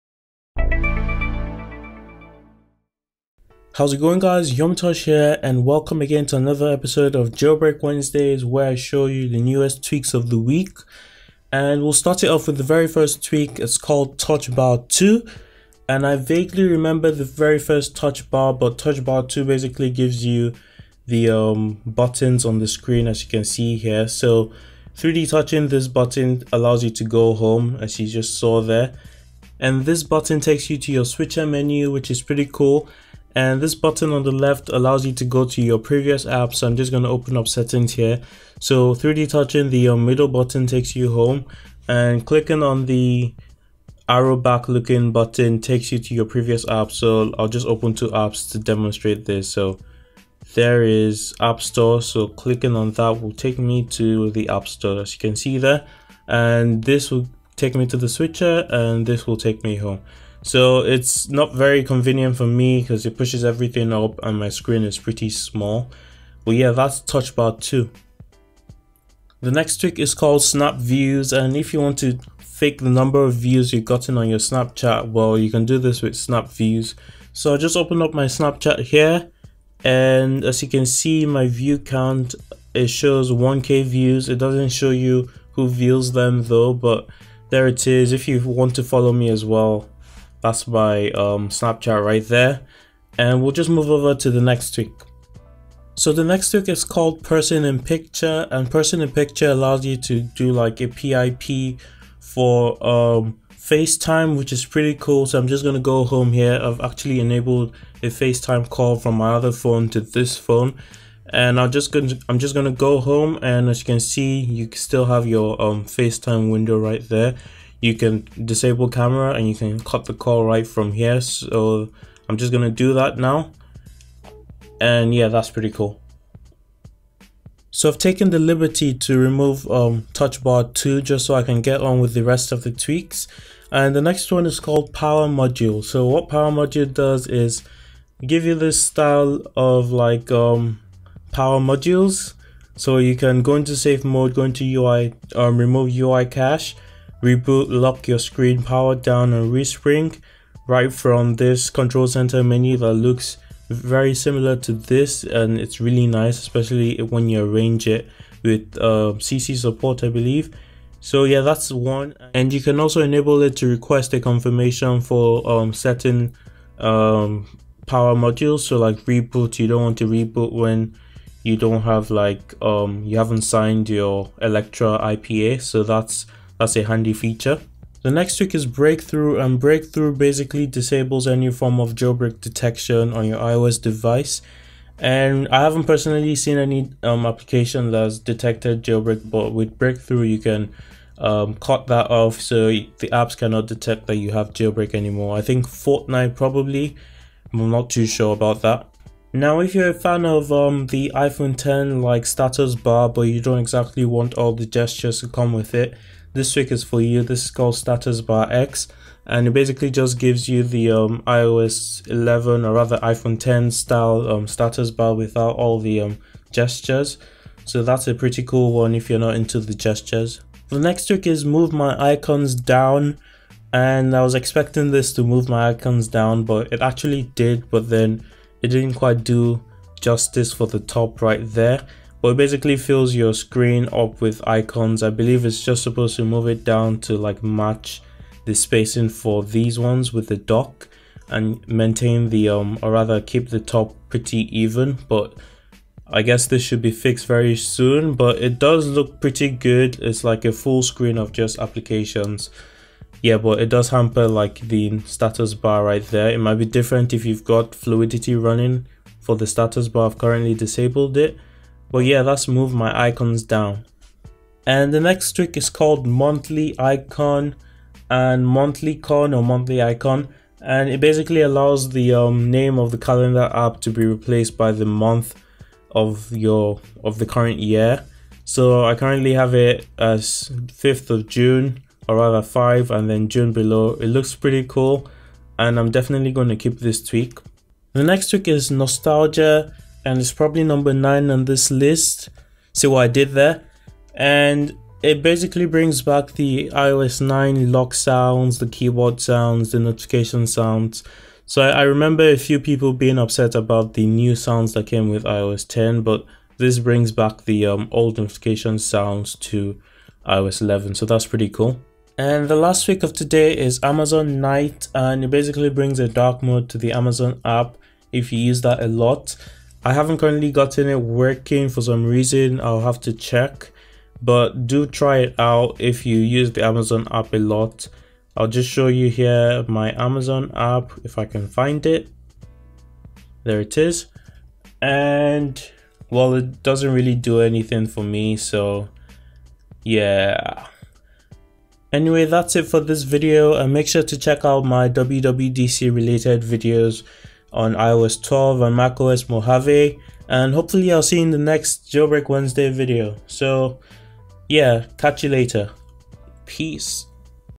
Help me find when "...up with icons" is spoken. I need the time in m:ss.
3:53.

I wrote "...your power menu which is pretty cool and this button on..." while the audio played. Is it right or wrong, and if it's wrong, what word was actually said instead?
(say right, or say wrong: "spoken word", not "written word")
wrong: "switcher", not "power".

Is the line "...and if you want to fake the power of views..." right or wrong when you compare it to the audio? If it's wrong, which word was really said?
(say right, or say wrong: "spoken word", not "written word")
wrong: "number", not "power".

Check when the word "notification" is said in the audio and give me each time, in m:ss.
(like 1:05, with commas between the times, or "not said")
4:59, 5:08.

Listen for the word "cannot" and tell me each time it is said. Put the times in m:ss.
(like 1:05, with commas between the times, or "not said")
3:13.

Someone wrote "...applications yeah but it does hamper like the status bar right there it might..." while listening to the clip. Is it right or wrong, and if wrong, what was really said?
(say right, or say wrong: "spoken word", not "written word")
right.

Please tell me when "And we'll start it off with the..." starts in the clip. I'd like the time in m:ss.
0:11.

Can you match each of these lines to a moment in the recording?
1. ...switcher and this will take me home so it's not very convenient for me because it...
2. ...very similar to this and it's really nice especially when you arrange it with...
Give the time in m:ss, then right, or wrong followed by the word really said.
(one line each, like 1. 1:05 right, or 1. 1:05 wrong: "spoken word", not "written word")
1. 0:58 right
2. 2:33 right.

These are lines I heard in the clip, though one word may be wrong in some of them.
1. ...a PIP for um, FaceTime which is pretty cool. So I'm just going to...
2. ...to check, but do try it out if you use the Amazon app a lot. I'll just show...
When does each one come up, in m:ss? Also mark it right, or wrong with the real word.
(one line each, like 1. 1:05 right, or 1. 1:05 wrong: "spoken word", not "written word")
1. 1:40 right
2. 5:23 right.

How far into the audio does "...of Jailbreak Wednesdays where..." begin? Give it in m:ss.
0:07.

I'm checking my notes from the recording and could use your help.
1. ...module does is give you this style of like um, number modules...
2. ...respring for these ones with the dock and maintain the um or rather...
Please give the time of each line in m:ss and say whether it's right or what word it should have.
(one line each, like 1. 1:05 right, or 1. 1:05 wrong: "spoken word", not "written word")
1. 2:16 wrong: "power", not "number"
2. 3:58 wrong: "spacing", not "respring".